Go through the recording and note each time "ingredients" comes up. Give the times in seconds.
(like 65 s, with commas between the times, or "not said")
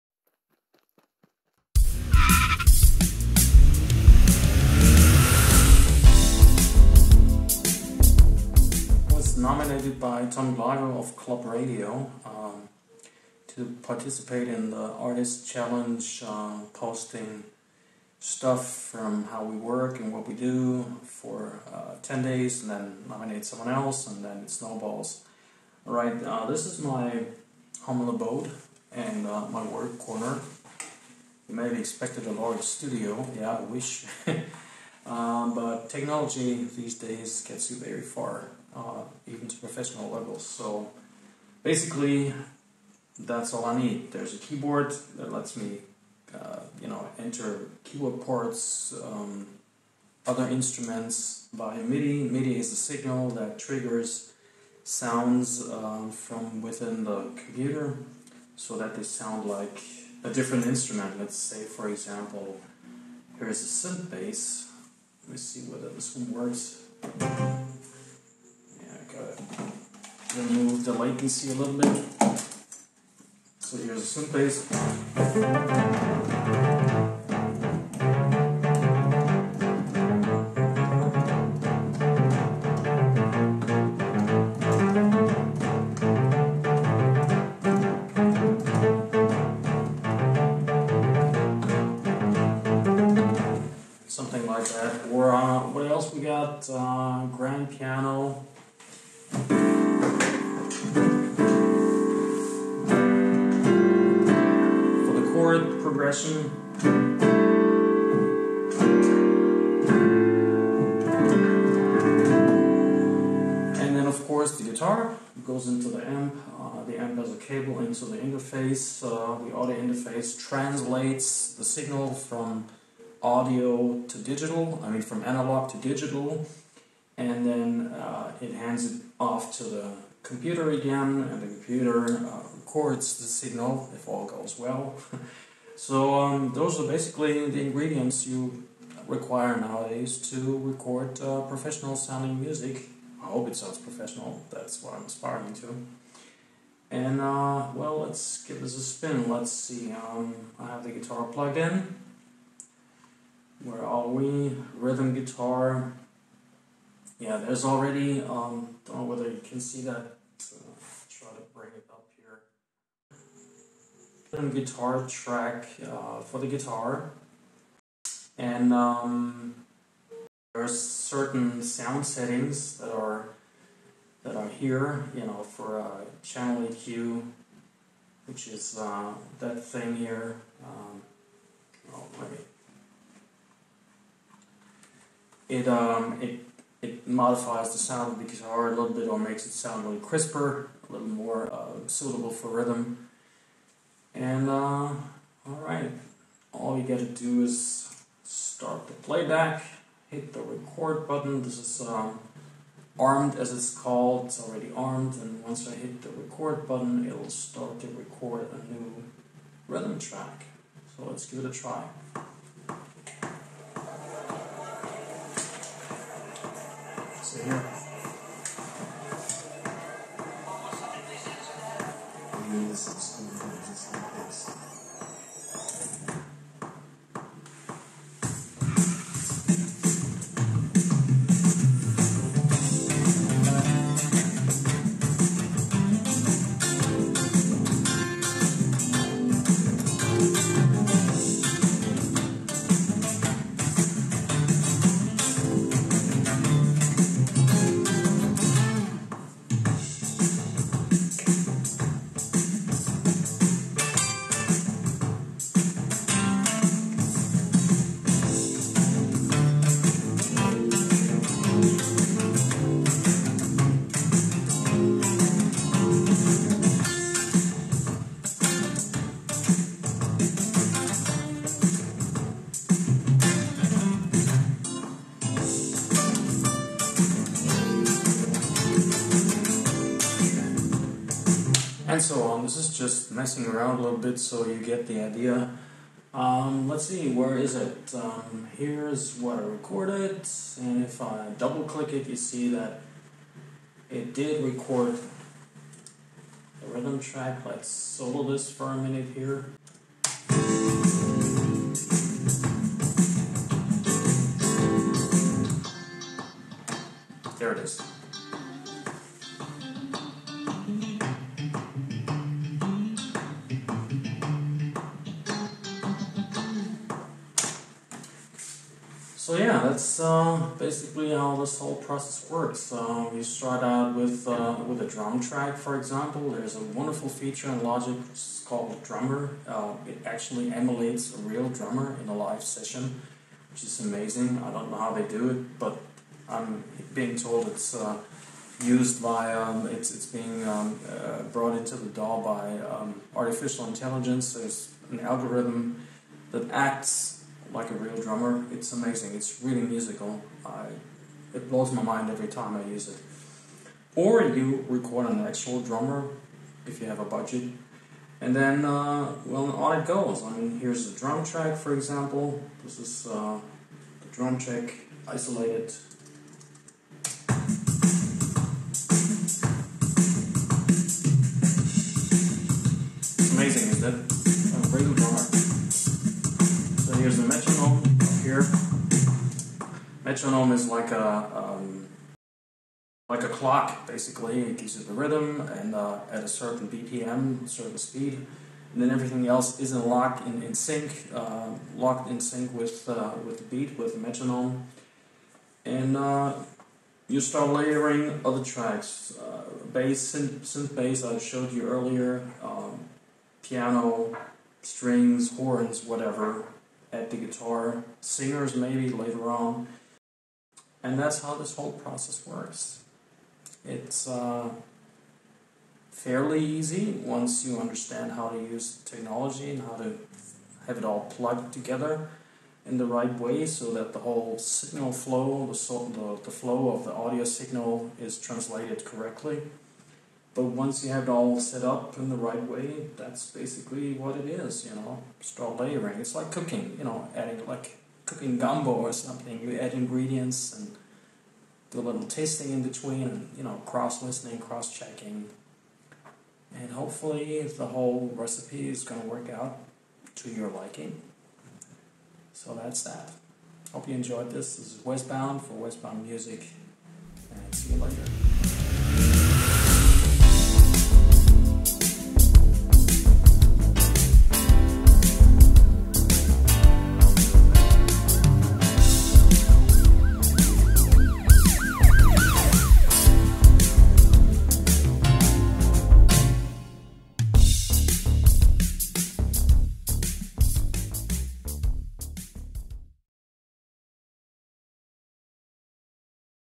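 137 s, 439 s.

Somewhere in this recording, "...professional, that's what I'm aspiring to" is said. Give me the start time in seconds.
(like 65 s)
143 s.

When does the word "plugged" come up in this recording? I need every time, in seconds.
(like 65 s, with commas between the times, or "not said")
151 s, 421 s.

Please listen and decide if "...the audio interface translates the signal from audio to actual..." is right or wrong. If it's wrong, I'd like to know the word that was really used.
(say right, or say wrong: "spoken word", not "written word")
wrong: "digital", not "actual".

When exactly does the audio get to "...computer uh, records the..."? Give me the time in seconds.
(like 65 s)
131 s.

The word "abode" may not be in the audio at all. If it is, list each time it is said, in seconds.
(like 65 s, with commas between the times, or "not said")
28 s.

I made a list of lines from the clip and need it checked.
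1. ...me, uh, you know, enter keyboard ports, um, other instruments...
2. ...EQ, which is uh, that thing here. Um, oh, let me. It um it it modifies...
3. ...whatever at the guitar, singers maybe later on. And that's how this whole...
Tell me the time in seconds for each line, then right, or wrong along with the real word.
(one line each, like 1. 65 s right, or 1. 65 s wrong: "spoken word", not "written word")
1. 45 s right
2. 176 s right
3. 405 s right.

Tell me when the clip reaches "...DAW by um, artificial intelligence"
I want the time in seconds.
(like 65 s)
341 s.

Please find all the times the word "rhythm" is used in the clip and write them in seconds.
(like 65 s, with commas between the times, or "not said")
154 s, 192 s, 209 s, 296 s, 384 s.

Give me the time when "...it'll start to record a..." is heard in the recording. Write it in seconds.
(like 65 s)
207 s.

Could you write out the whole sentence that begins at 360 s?
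I mean, here's the drum track, for example.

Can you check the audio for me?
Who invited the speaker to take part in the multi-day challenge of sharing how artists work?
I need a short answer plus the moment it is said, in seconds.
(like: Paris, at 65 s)
Tom Gliver, at 10 s.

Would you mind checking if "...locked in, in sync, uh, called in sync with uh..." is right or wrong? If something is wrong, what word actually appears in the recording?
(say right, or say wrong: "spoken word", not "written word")
wrong: "locked", not "called".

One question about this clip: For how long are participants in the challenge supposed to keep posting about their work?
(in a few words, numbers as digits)
10 days.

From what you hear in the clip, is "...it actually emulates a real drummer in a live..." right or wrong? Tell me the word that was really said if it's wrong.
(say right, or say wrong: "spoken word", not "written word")
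right.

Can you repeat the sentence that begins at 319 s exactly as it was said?
So yeah, that's uh, basically how this whole process works.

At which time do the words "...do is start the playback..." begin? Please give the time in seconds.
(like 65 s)
197 s.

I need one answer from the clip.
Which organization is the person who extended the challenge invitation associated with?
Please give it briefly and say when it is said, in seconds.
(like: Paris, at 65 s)
Club Radio, at 11 s.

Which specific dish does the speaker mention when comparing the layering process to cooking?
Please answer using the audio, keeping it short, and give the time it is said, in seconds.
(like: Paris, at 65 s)
gumbo, at 438 s.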